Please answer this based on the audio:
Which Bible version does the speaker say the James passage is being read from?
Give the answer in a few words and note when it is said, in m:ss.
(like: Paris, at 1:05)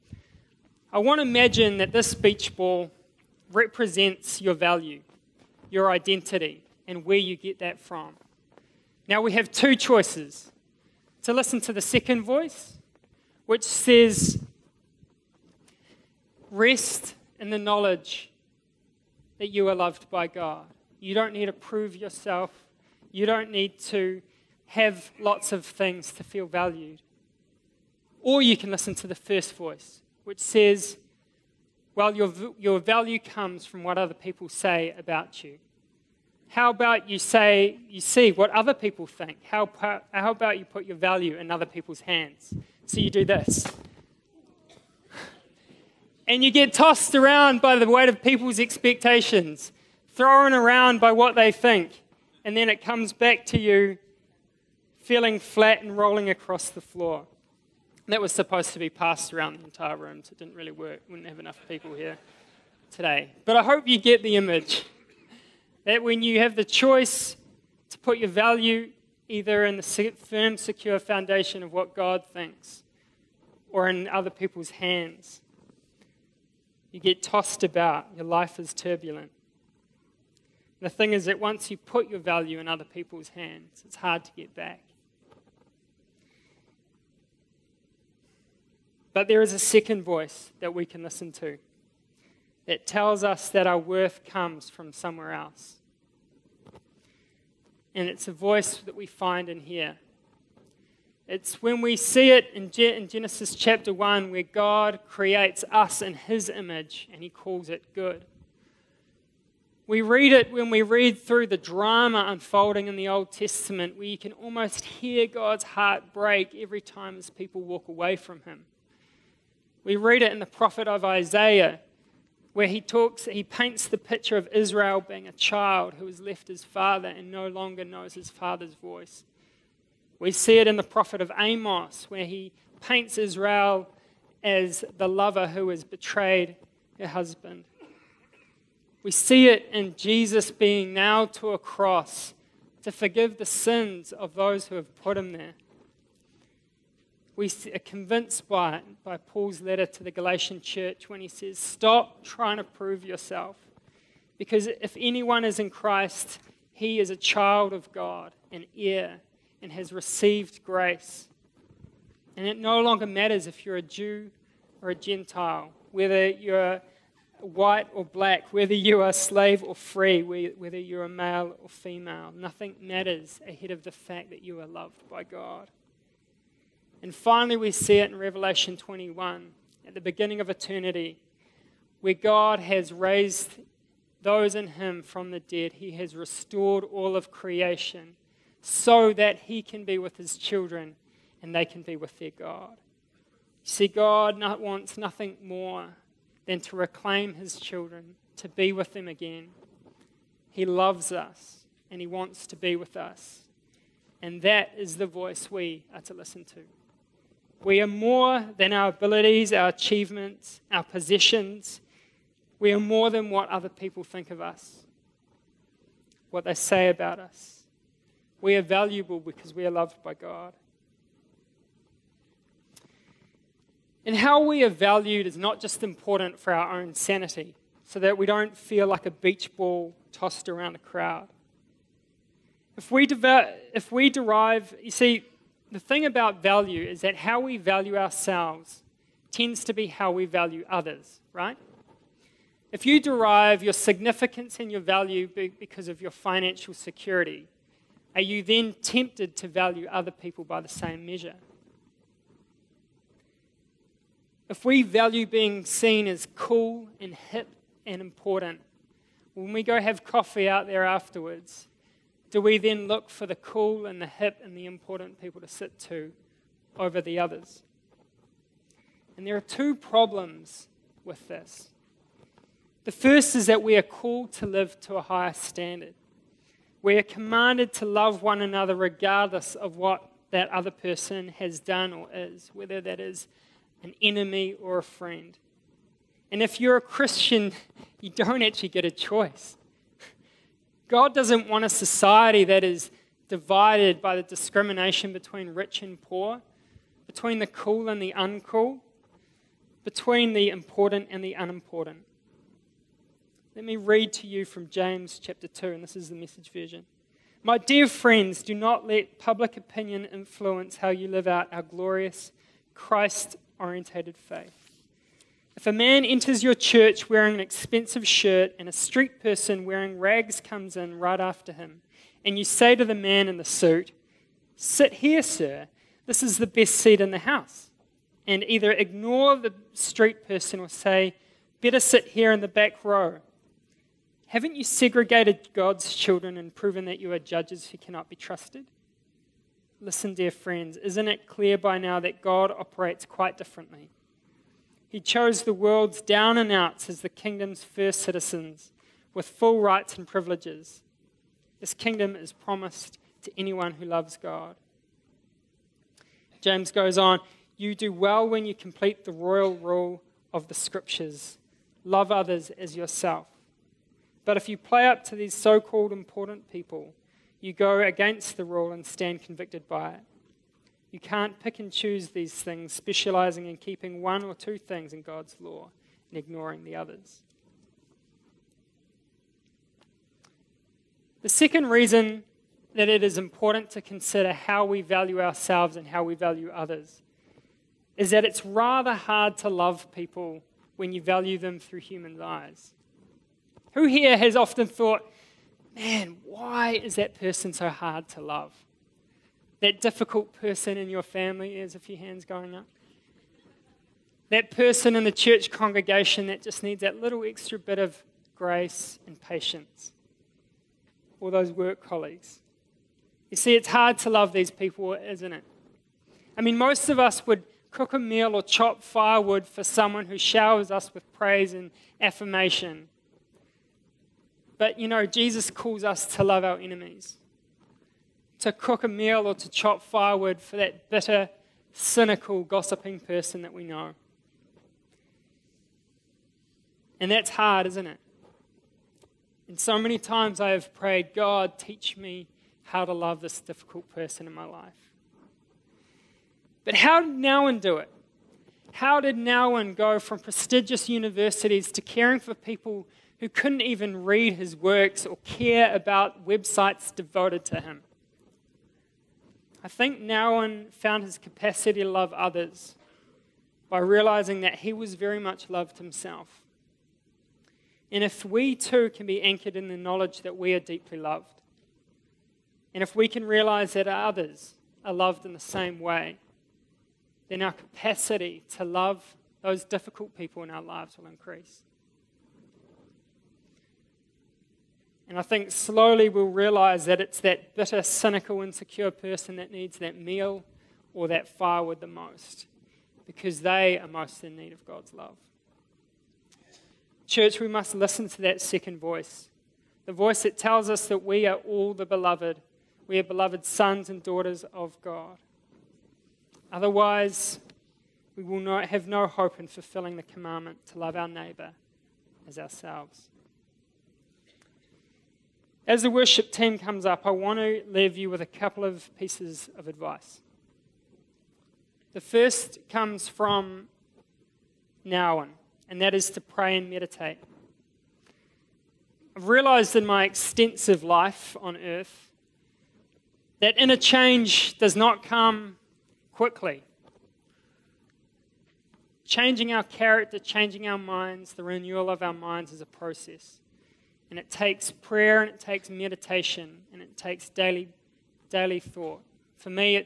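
The Message, at 5:06.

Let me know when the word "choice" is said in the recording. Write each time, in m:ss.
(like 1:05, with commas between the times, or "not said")
0:09, 1:06, 4:48.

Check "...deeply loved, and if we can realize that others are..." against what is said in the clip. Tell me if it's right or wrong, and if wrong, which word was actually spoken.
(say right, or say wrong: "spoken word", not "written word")
right.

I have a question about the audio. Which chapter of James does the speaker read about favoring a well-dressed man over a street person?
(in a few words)
James chapter 2.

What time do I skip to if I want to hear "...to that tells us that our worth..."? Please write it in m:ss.
1:31.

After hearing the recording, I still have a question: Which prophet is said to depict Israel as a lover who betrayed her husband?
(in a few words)
Amos.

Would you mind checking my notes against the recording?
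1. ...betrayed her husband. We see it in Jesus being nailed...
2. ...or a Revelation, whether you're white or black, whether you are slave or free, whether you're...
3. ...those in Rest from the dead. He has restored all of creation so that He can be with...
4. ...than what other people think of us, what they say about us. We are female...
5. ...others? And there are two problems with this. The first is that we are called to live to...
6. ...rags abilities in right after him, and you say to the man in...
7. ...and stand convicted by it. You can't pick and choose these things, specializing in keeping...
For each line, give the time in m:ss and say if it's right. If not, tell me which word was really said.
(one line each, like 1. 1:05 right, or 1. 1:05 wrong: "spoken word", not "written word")
1. 2:15 right
2. 2:44 wrong: "Gentile", not "Revelation"
3. 3:04 wrong: "Him", not "Rest"
4. 3:33 wrong: "valuable", not "female"
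5. 4:27 right
6. 5:19 wrong: "comes", not "abilities"
7. 6:08 right.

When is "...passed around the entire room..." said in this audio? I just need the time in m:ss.
0:58.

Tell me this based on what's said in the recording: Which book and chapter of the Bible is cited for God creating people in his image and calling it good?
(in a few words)
Genesis chapter 1.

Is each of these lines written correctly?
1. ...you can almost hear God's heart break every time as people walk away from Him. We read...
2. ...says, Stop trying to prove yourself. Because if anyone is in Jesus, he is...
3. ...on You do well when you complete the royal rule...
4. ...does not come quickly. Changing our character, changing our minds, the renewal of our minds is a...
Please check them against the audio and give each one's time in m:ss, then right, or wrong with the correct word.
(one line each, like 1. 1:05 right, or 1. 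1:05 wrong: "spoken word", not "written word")
1. 1:54 right
2. 2:31 wrong: "Christ", not "Jesus"
3. 5:56 right
4. 8:54 right.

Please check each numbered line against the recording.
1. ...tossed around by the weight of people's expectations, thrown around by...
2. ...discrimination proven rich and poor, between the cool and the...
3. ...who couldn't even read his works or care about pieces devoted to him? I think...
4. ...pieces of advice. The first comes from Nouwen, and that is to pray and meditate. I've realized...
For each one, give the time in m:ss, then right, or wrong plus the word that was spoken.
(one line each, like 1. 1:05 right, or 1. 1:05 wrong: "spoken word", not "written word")
1. 0:46 right
2. 4:54 wrong: "between", not "proven"
3. 7:33 wrong: "websites", not "pieces"
4. 8:38 right.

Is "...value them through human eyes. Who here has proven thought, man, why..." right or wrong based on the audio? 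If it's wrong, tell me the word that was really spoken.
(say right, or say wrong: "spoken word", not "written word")
wrong: "often", not "proven".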